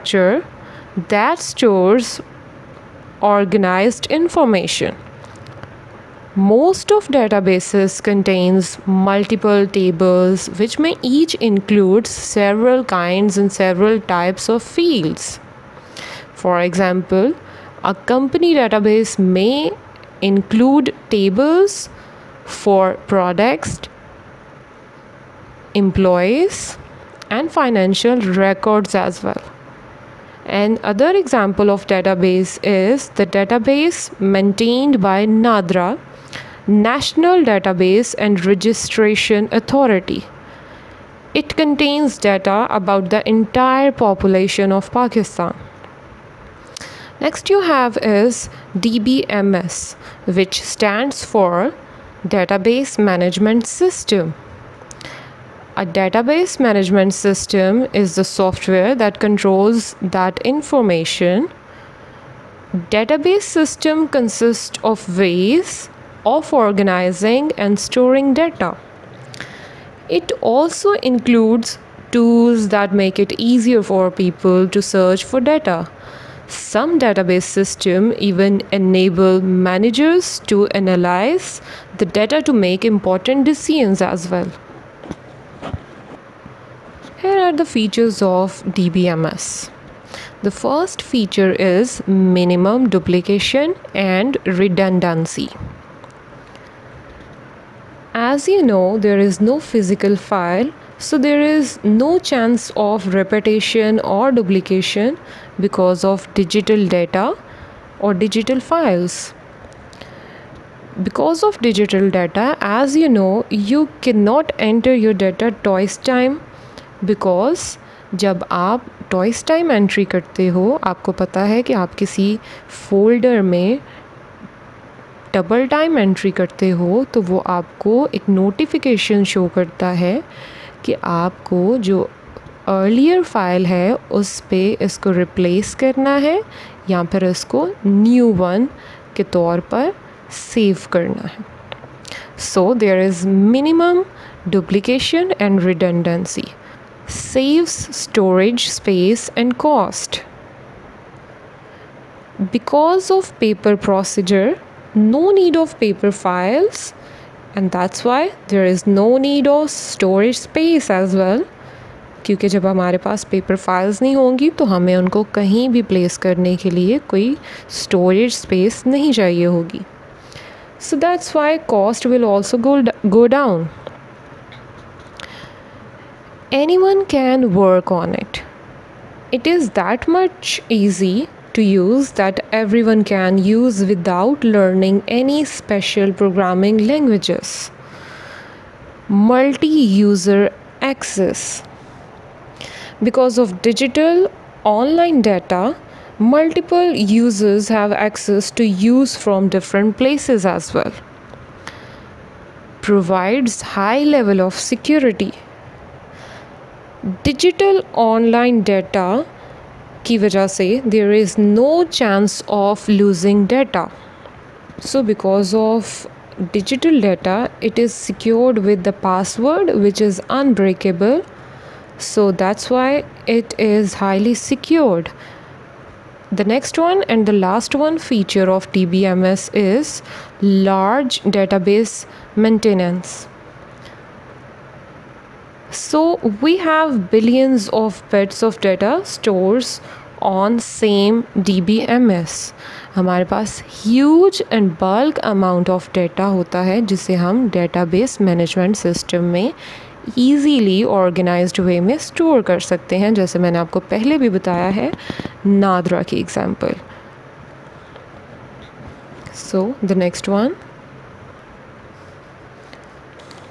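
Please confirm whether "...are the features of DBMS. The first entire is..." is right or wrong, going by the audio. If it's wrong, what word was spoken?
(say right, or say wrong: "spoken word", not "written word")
wrong: "feature", not "entire".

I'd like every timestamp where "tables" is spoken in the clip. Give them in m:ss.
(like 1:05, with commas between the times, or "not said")
0:09, 0:21.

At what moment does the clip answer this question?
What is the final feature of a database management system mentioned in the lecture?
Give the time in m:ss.
3:50.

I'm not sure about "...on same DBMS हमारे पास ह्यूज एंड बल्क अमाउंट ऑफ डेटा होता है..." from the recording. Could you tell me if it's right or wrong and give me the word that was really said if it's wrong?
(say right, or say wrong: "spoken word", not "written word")
right.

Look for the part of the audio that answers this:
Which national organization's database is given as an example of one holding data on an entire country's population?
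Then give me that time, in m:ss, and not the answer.
0:35.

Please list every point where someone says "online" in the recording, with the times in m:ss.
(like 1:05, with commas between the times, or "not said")
3:14, 3:27.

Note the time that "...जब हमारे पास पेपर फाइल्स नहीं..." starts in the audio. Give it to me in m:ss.
2:42.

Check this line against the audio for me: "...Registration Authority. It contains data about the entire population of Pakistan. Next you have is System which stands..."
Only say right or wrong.
wrong.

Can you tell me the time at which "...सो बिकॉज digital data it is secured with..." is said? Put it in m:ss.
3:34.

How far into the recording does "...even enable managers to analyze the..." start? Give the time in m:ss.
1:18.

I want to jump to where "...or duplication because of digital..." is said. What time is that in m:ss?
1:43.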